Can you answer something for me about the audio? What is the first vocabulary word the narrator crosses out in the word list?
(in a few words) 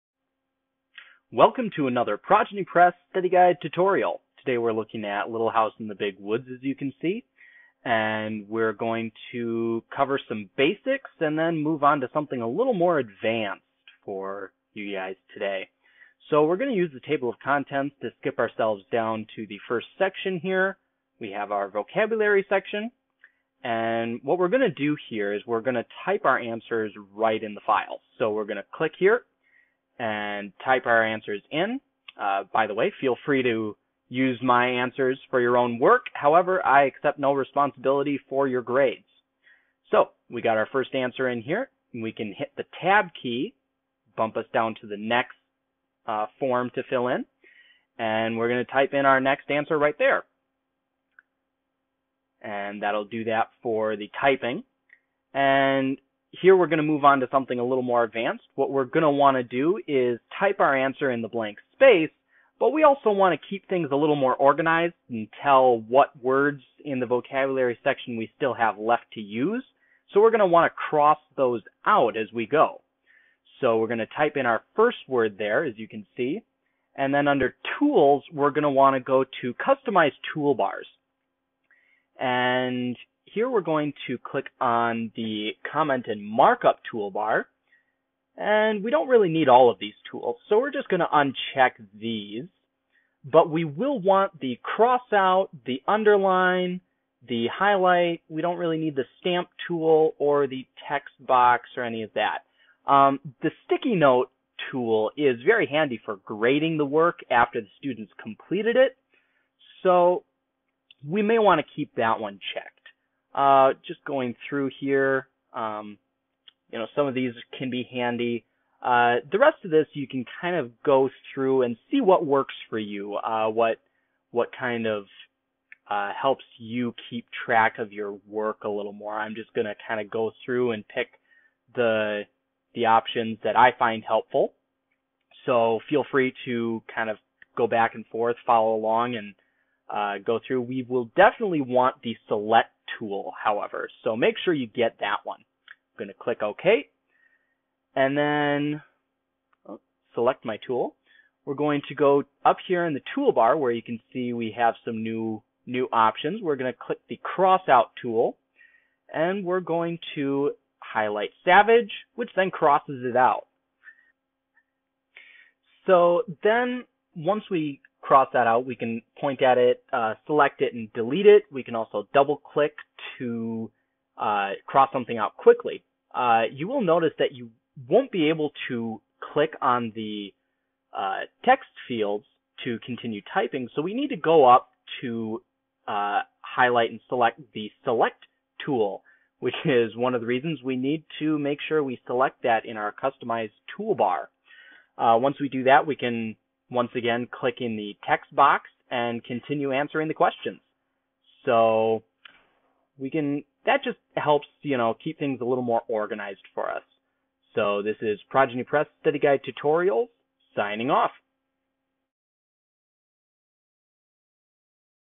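Savage.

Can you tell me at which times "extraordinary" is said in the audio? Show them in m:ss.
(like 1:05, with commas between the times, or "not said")
not said.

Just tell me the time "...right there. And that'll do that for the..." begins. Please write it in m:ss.
0:49.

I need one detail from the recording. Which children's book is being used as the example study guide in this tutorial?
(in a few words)
Little House in the Big Woods.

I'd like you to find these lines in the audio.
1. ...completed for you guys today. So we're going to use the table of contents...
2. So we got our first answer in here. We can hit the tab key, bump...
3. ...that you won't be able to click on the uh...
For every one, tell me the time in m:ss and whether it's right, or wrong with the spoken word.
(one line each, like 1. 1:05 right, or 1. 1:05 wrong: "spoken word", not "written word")
1. 0:12 wrong: "advanced", not "completed"
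2. 0:39 right
3. 2:57 right.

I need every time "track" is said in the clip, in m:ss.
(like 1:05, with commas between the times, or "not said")
2:07.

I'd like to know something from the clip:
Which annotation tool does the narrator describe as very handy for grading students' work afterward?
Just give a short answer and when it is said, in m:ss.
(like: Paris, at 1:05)
sticky note tool, at 1:43.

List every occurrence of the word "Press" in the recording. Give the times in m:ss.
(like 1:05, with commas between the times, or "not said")
0:02, 3:28.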